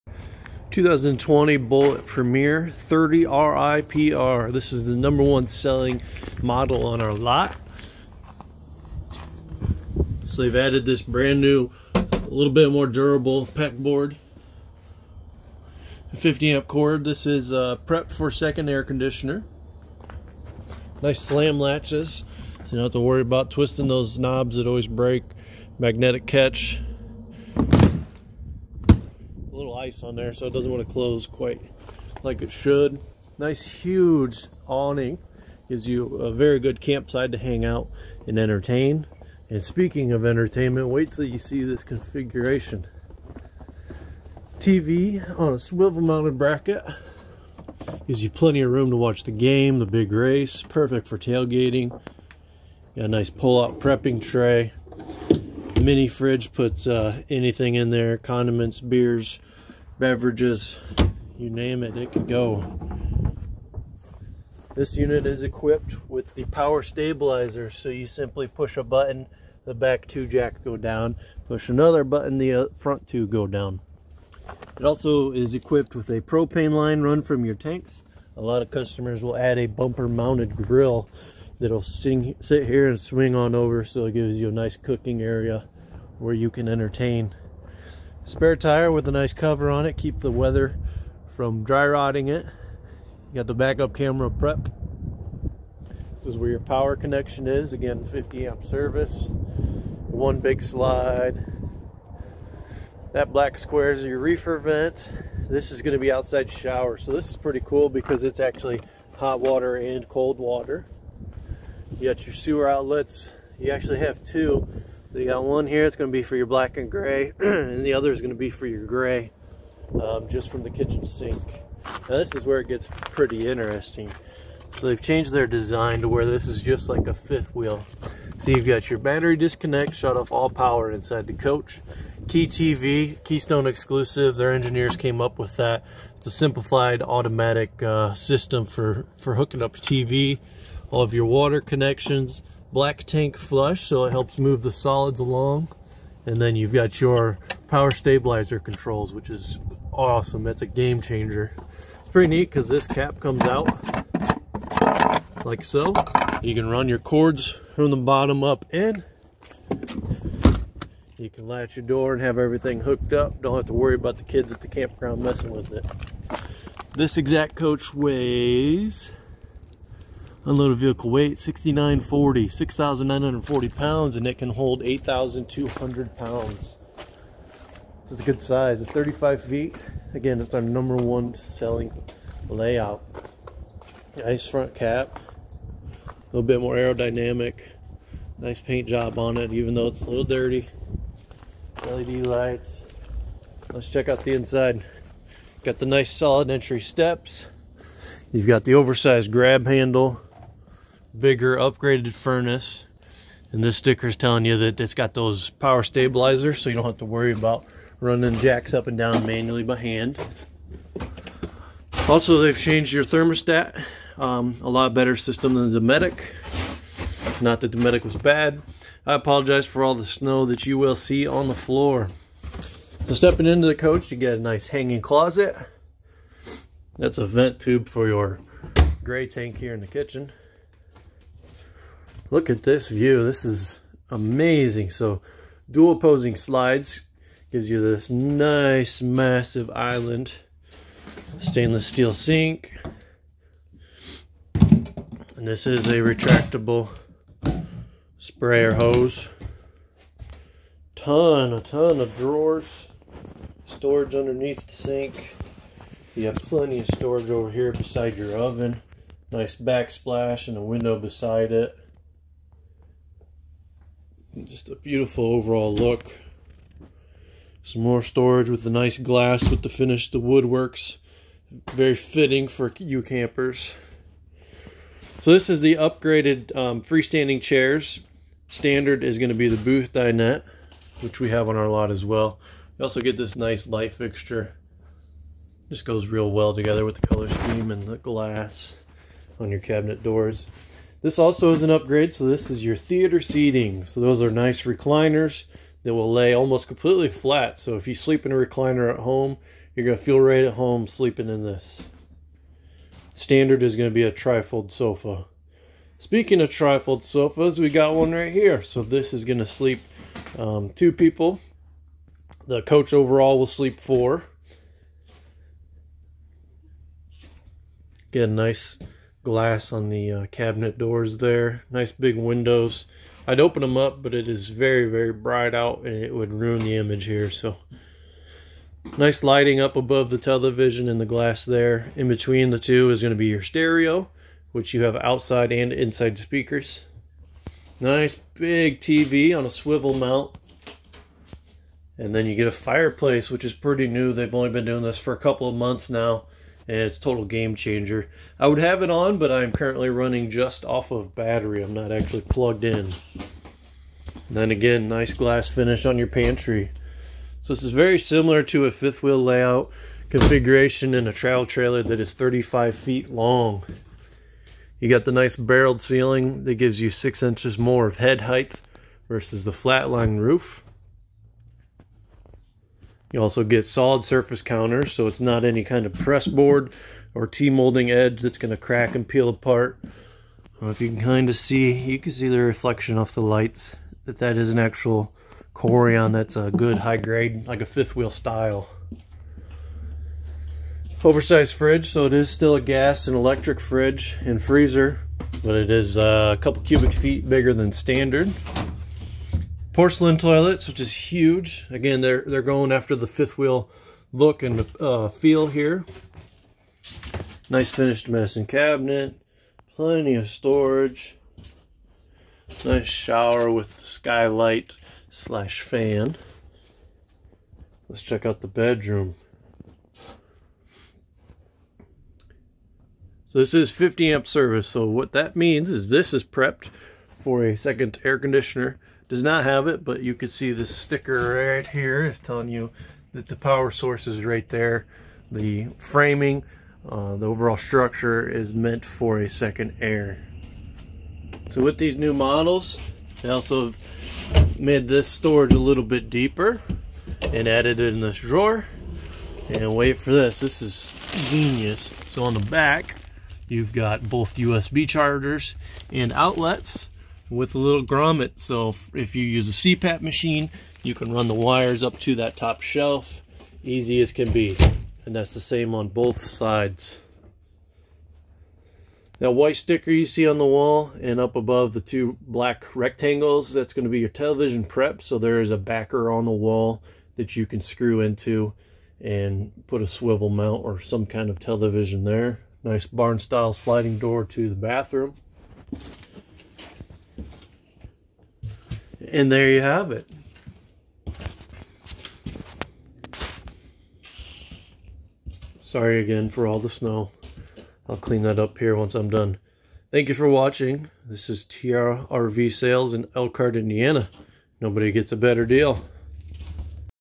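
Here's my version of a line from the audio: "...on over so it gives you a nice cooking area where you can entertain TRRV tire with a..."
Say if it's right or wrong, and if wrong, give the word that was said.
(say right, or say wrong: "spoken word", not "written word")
wrong: "Spare", not "TRRV".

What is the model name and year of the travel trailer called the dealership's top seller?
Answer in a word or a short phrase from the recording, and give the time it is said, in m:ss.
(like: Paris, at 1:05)
2020 Bullet Premier 30 RIPR, at 0:00.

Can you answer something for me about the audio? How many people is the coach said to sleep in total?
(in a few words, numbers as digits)
4.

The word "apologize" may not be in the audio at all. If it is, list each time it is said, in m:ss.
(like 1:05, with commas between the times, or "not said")
3:39.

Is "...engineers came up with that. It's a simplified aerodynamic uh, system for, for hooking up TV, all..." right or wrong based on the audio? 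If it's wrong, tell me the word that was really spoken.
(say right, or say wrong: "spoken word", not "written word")
wrong: "automatic", not "aerodynamic".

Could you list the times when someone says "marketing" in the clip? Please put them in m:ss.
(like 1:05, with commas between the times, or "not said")
not said.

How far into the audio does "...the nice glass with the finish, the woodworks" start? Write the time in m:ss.
4:28.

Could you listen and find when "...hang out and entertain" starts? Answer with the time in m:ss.
0:37.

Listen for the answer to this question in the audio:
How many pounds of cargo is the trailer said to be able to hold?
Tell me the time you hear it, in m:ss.
2:54.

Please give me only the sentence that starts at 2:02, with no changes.
Now this is where it gets pretty interesting.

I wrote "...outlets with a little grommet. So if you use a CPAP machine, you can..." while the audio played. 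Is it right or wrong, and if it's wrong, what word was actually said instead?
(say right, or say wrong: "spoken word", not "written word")
right.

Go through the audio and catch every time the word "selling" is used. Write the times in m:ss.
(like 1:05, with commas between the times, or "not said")
0:05, 3:01.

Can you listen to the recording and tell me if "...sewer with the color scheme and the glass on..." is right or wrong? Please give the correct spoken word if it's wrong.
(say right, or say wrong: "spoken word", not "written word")
wrong: "together", not "sewer".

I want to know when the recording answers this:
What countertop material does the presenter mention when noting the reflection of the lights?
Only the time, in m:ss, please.
6:25.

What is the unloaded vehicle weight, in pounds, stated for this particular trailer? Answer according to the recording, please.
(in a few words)
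6,940.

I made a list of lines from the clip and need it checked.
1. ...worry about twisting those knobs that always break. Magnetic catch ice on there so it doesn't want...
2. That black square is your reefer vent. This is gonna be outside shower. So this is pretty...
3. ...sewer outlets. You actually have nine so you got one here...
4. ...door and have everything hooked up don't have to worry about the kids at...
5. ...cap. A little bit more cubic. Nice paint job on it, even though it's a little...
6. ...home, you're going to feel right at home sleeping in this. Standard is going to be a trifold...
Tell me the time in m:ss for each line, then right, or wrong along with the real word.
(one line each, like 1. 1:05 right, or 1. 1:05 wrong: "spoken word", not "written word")
1. 0:23 right
2. 1:43 right
3. 1:52 wrong: "two", not "nine"
4. 2:41 right
5. 3:04 wrong: "aerodynamic", not "cubic"
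6. 4:58 right.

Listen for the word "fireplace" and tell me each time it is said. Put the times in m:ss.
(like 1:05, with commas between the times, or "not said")
5:42.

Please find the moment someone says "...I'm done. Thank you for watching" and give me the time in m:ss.
8:18.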